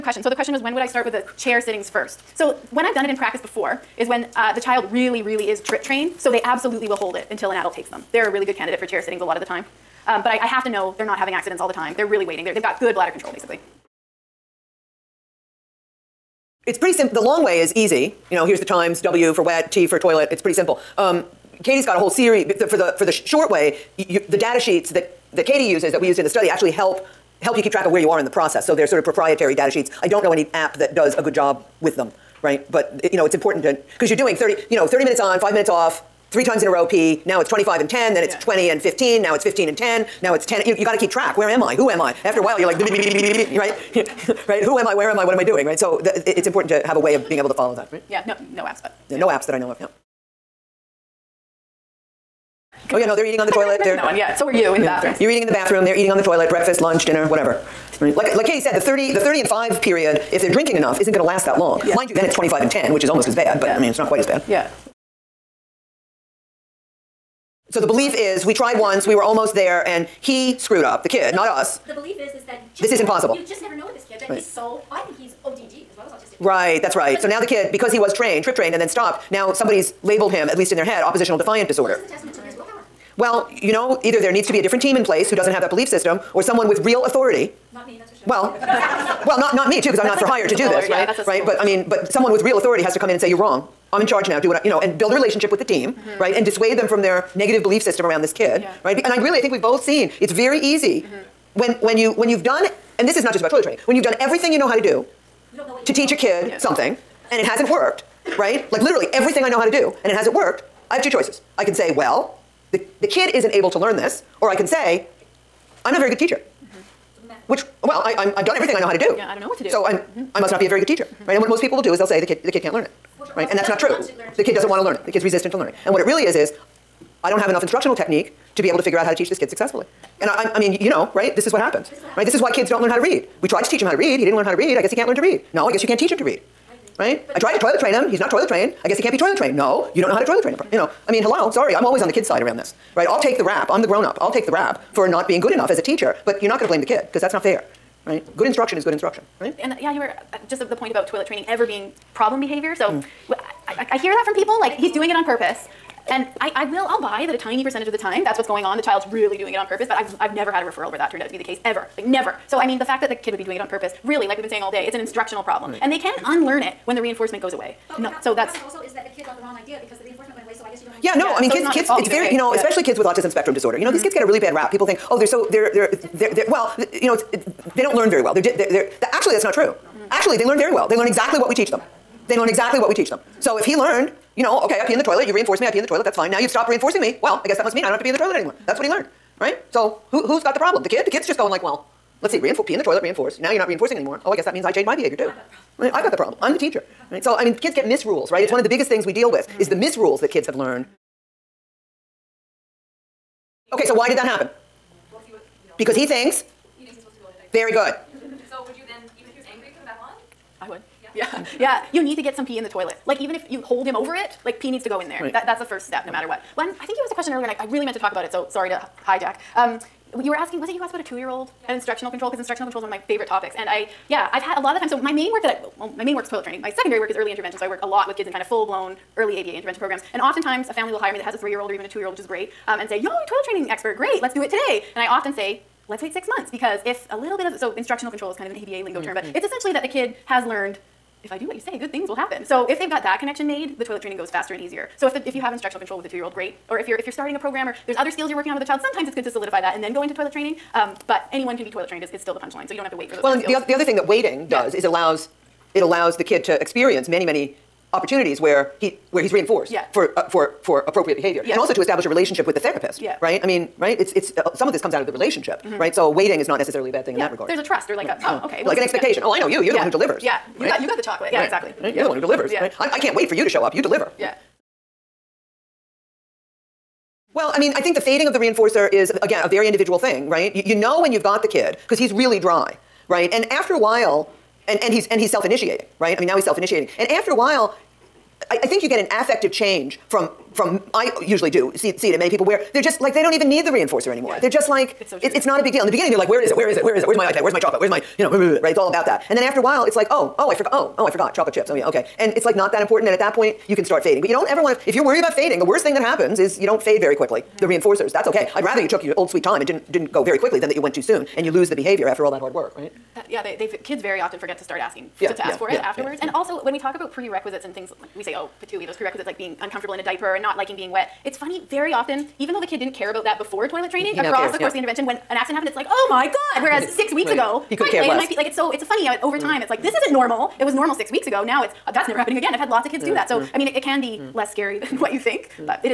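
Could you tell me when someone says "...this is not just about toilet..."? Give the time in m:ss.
1:43.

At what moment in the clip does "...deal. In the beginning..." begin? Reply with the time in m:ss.
4:55.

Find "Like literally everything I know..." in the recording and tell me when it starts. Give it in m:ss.
1:48.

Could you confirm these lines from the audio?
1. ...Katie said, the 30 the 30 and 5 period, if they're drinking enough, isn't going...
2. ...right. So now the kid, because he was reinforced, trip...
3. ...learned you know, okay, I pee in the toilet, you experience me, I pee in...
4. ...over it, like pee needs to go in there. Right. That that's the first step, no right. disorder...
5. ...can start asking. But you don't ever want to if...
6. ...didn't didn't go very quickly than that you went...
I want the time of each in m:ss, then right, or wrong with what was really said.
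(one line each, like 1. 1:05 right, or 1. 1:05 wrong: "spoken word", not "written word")
1. 0:58 right
2. 1:16 wrong: "trained", not "reinforced"
3. 3:03 wrong: "reinforce", not "experience"
4. 3:33 wrong: "matter", not "disorder"
5. 5:03 wrong: "fading", not "asking"
6. 5:09 right.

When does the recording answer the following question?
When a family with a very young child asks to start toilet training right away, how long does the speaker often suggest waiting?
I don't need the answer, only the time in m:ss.
3:56.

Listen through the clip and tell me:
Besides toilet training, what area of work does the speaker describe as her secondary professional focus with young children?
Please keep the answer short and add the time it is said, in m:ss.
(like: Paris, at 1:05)
Early intervention, at 3:47.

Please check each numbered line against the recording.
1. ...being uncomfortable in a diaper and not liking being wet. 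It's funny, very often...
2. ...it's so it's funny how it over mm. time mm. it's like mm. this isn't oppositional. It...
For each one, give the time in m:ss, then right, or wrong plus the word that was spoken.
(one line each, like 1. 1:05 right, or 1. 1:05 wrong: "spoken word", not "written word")
1. 5:19 right
2. 5:28 wrong: "normal", not "oppositional".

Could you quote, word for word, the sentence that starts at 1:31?
Yeah, right, but I mean, but someone with real authority has to come in and say you're wrong.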